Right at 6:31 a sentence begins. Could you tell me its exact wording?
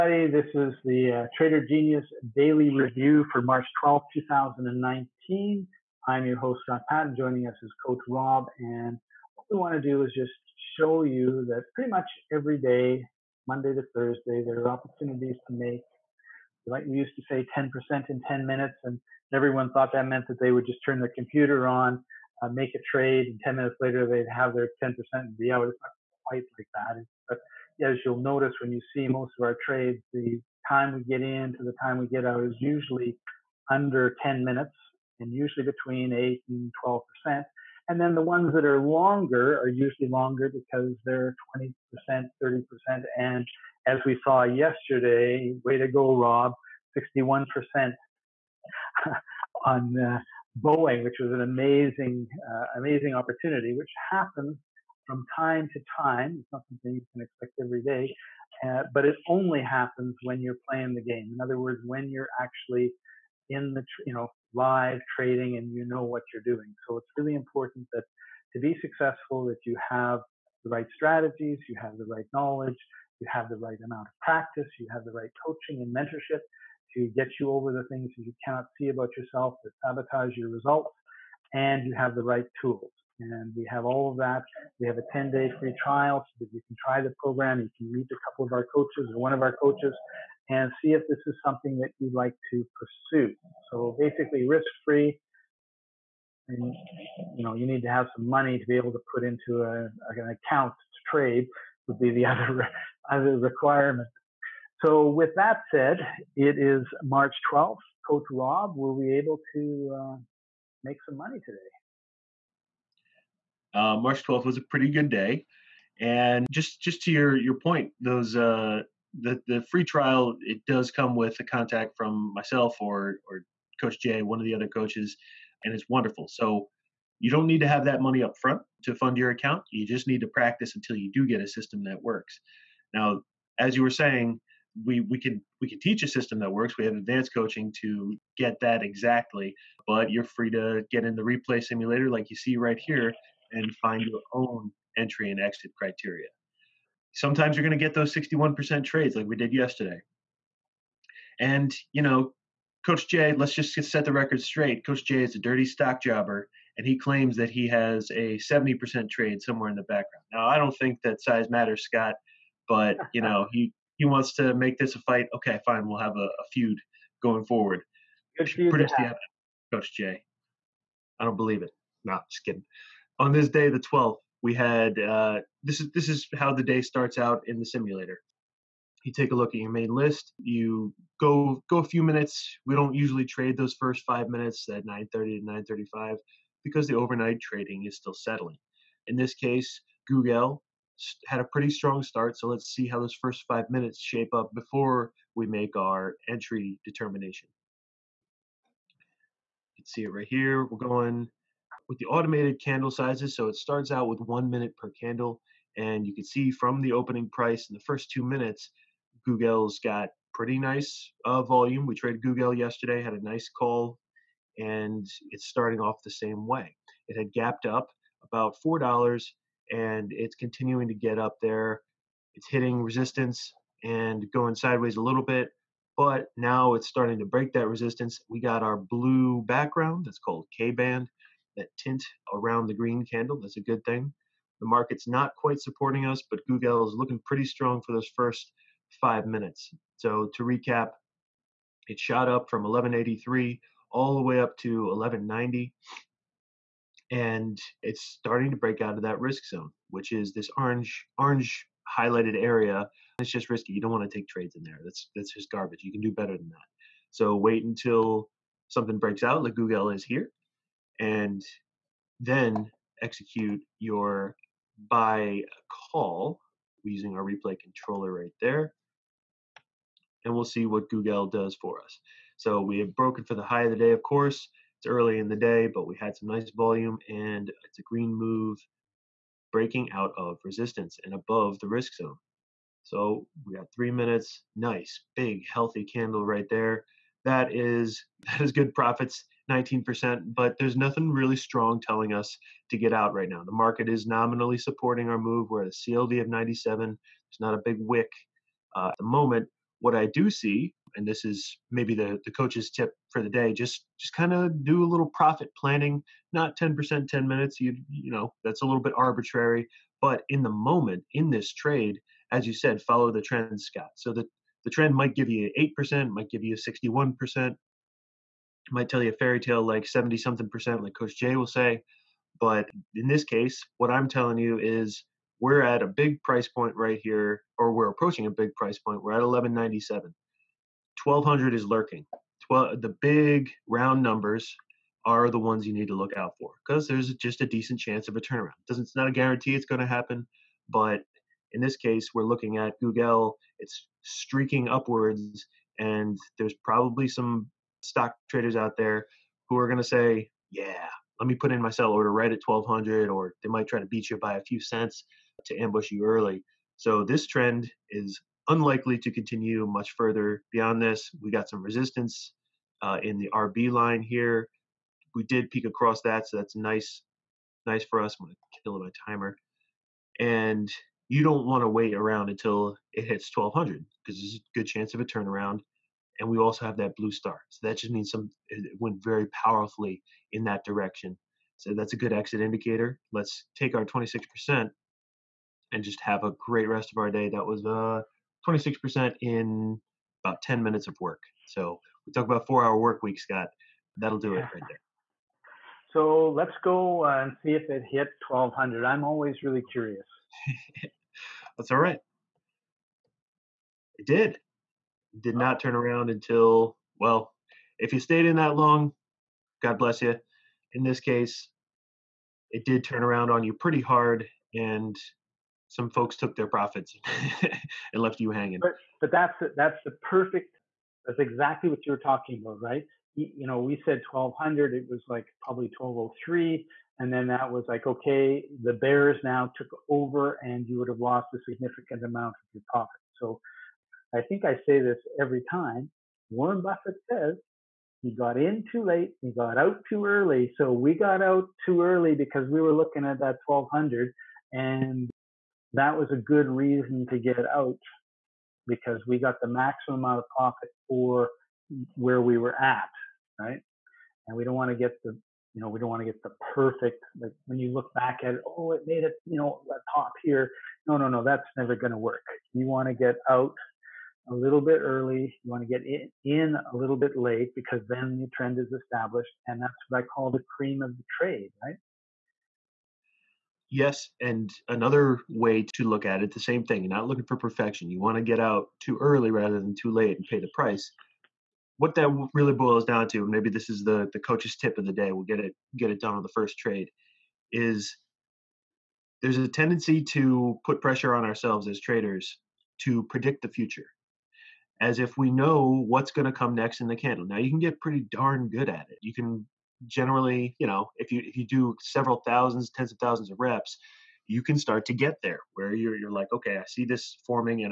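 So we talk about four hour work week, Scott.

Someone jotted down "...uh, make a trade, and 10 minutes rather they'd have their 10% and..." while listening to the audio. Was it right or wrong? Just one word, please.
wrong.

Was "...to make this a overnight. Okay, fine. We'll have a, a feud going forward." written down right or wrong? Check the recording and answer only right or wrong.
wrong.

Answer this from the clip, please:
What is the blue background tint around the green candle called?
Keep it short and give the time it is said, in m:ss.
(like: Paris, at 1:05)
K band, at 3:50.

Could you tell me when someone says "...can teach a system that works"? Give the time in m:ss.
2:15.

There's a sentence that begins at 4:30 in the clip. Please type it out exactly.
And we'll see what Google does for us.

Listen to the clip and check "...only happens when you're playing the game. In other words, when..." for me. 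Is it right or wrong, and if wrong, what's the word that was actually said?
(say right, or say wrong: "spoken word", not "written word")
right.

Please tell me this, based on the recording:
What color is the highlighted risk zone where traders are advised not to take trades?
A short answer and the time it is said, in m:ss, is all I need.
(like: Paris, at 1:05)
Orange, at 4:10.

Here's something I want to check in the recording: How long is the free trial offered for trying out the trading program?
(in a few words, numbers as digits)
10 days.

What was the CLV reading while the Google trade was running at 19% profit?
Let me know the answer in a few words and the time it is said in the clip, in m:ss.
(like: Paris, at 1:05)
97, at 4:56.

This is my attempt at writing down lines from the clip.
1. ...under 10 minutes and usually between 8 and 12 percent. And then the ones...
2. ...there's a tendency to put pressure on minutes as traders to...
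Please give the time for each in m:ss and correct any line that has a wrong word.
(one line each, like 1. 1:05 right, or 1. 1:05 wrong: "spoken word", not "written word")
1. 0:33 right
2. 8:09 wrong: "ourselves", not "minutes".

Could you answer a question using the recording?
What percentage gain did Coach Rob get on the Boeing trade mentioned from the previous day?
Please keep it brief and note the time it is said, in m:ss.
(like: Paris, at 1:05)
61%, at 0:46.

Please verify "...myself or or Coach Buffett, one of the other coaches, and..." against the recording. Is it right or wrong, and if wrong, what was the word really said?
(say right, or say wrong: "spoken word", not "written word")
wrong: "Jay", not "Buffett".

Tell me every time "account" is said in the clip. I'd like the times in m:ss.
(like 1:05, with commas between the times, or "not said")
1:40, 2:09.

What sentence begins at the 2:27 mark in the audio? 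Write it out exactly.
Sometimes you're going to get those 61% trades like we did yesterday.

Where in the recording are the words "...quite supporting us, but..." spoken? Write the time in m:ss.
3:55.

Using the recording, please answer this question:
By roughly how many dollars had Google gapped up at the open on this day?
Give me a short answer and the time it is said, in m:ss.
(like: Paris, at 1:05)
$4, at 3:38.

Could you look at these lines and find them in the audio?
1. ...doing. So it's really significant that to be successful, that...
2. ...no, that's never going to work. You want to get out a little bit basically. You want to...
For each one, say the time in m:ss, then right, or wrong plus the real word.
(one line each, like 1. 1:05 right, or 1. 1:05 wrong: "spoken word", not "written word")
1. 1:06 wrong: "important", not "significant"
2. 7:41 wrong: "early", not "basically".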